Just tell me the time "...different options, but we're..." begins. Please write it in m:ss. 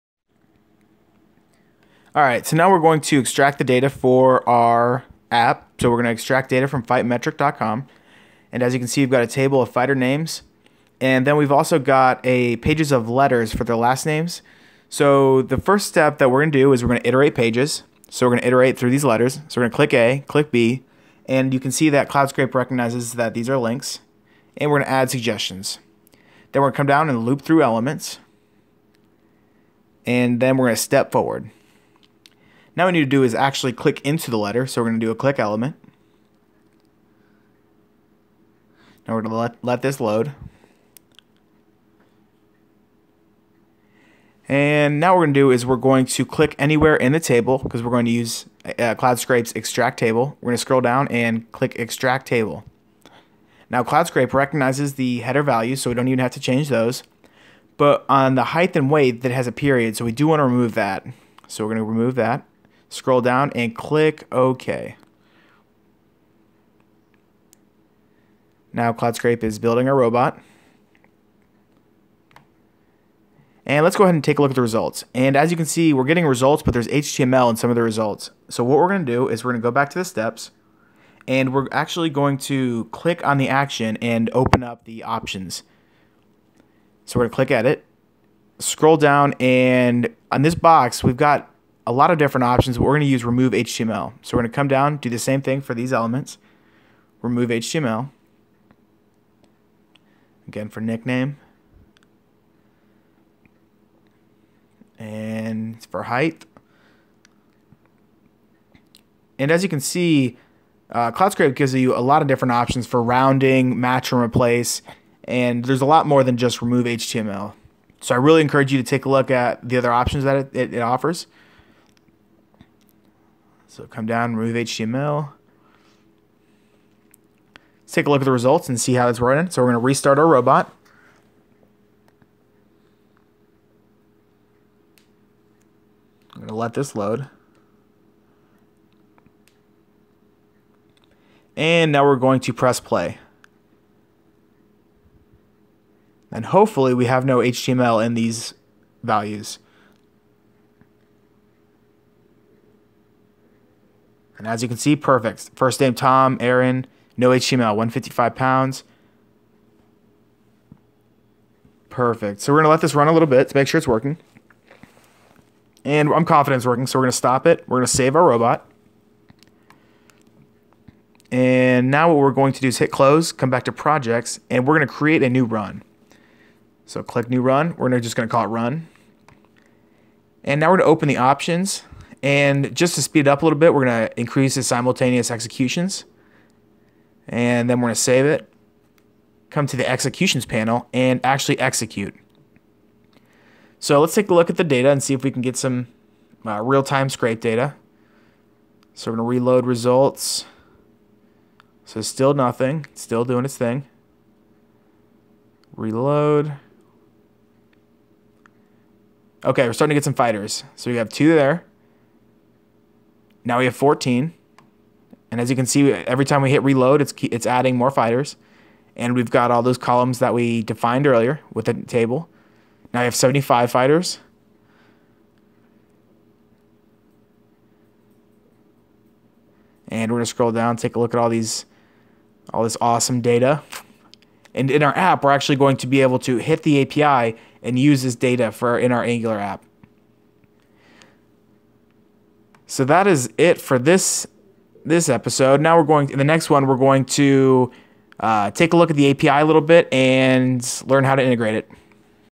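1:32.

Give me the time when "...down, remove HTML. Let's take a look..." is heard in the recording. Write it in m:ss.
2:04.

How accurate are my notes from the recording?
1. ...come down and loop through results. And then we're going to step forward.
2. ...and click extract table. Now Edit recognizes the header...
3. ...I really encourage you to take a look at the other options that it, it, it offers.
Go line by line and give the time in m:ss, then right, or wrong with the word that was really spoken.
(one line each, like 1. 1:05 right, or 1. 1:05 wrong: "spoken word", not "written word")
1. 0:26 wrong: "elements", not "results"
2. 0:51 wrong: "CloudScrape", not "Edit"
3. 1:58 right.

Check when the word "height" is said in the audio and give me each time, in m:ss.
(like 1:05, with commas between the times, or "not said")
0:58, 1:46.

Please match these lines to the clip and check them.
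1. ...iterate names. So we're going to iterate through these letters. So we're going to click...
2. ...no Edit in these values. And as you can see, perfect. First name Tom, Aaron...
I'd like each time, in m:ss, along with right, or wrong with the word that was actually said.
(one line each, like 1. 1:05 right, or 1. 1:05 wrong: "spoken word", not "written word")
1. 0:17 wrong: "pages", not "names"
2. 2:27 wrong: "HTML", not "Edit".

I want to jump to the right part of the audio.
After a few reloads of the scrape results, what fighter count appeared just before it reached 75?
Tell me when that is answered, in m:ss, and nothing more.
3:33.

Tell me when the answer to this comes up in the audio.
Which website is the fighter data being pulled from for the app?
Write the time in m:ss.
0:06.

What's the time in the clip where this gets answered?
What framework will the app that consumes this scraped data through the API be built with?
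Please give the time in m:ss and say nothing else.
3:59.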